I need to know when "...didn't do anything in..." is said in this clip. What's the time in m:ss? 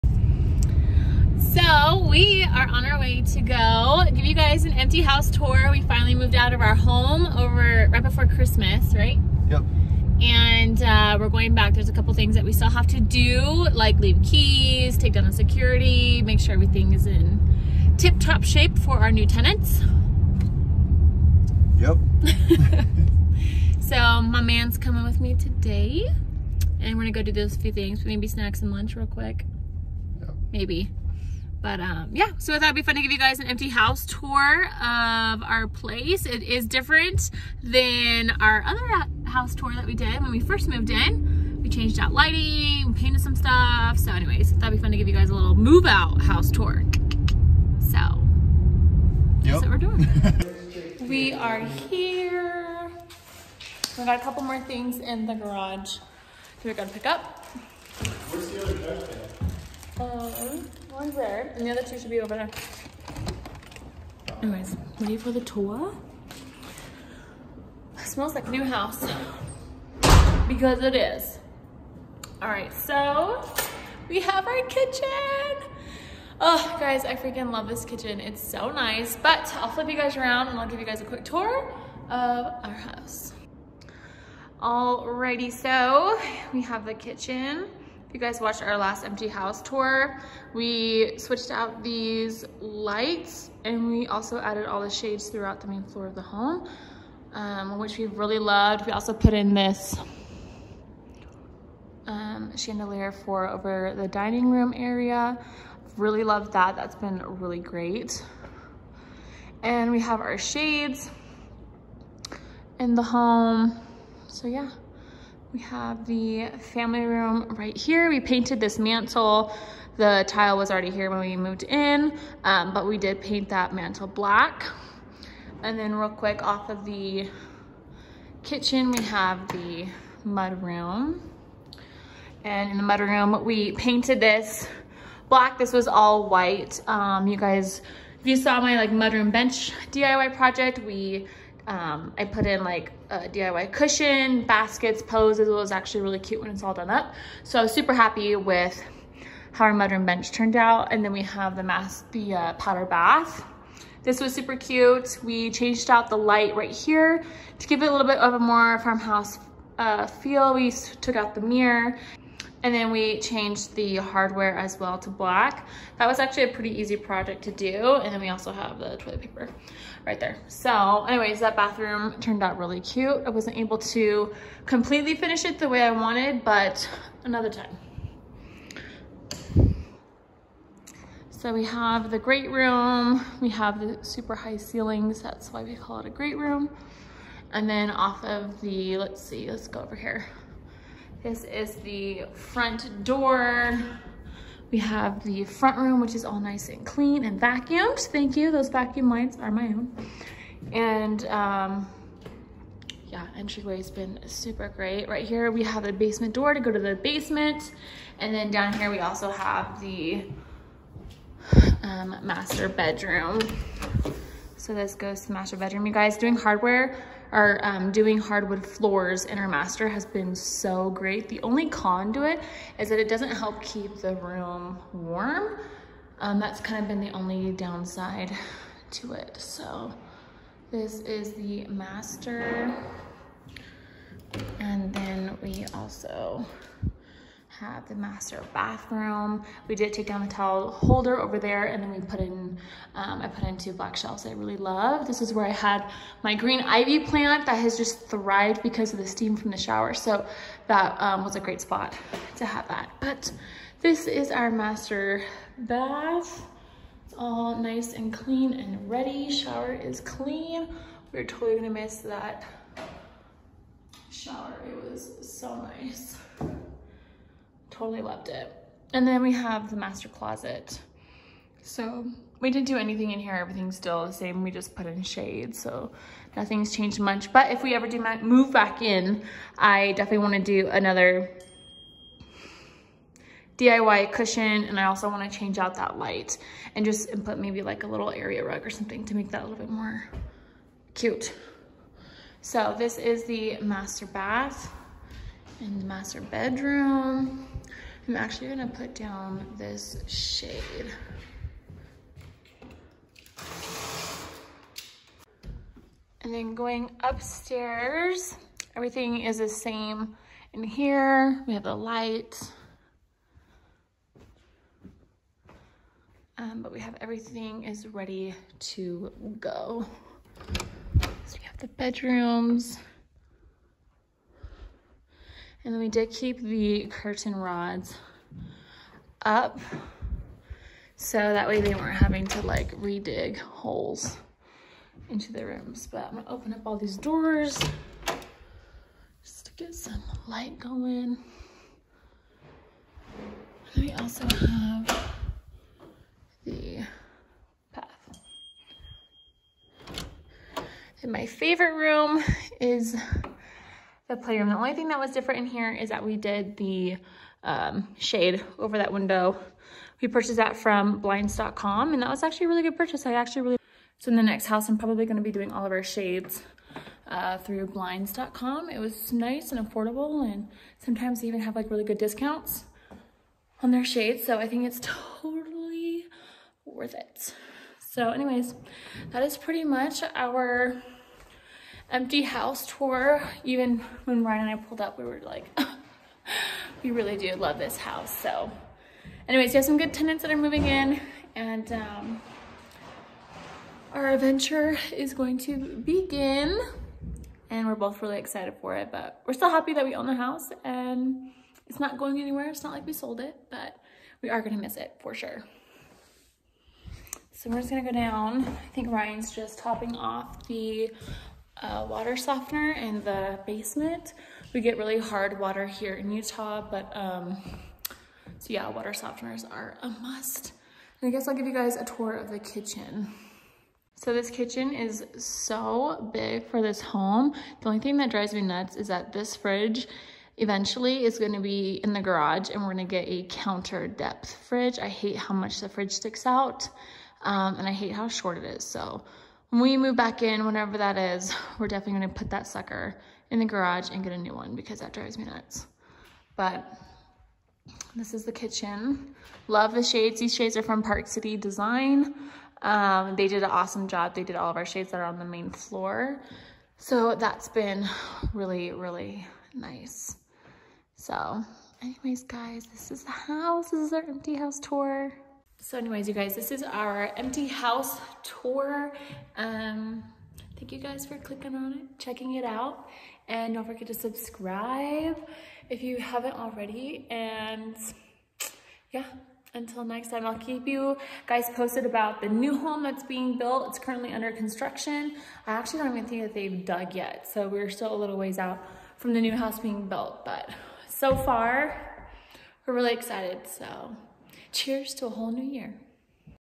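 4:32.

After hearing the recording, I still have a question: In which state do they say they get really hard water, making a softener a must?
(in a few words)
Utah.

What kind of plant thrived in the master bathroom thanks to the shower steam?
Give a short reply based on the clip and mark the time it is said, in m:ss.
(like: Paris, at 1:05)
Green ivy, at 4:06.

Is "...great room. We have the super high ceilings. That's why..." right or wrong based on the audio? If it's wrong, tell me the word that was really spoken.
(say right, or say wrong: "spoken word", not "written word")
right.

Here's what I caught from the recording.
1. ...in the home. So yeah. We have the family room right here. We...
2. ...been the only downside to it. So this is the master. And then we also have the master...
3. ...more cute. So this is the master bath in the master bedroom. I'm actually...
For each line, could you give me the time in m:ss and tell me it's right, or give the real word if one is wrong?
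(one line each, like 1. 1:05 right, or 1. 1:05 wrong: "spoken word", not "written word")
1. 1:52 right
2. 3:46 right
3. 4:49 right.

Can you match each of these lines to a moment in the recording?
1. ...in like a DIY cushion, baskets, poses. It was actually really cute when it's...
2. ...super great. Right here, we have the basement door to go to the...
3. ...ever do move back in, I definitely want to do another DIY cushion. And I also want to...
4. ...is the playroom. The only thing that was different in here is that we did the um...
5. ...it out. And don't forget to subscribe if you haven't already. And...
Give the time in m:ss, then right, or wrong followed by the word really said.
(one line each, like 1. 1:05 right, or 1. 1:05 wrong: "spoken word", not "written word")
1. 2:22 right
2. 3:24 right
3. 4:37 right
4. 5:52 right
5. 7:52 right.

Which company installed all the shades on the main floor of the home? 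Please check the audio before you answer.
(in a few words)
Park City Design.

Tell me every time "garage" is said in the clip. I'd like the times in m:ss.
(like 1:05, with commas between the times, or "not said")
0:55, 7:12, 7:23.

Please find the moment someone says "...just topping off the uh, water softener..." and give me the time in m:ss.
6:49.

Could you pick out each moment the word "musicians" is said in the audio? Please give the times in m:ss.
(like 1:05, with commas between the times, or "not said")
not said.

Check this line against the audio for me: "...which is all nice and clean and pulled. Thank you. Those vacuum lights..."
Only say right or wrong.
wrong.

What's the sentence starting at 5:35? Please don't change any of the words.
But I'm gonna open up all these doors just to get some light going.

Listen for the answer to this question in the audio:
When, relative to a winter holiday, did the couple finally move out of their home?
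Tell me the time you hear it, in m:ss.
0:07.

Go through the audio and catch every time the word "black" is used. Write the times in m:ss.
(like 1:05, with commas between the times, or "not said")
2:04, 2:15, 2:45, 4:03.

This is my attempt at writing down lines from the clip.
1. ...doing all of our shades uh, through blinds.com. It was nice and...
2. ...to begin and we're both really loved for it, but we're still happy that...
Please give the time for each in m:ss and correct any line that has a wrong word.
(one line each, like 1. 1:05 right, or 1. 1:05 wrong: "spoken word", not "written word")
1. 6:05 right
2. 6:35 wrong: "excited", not "loved".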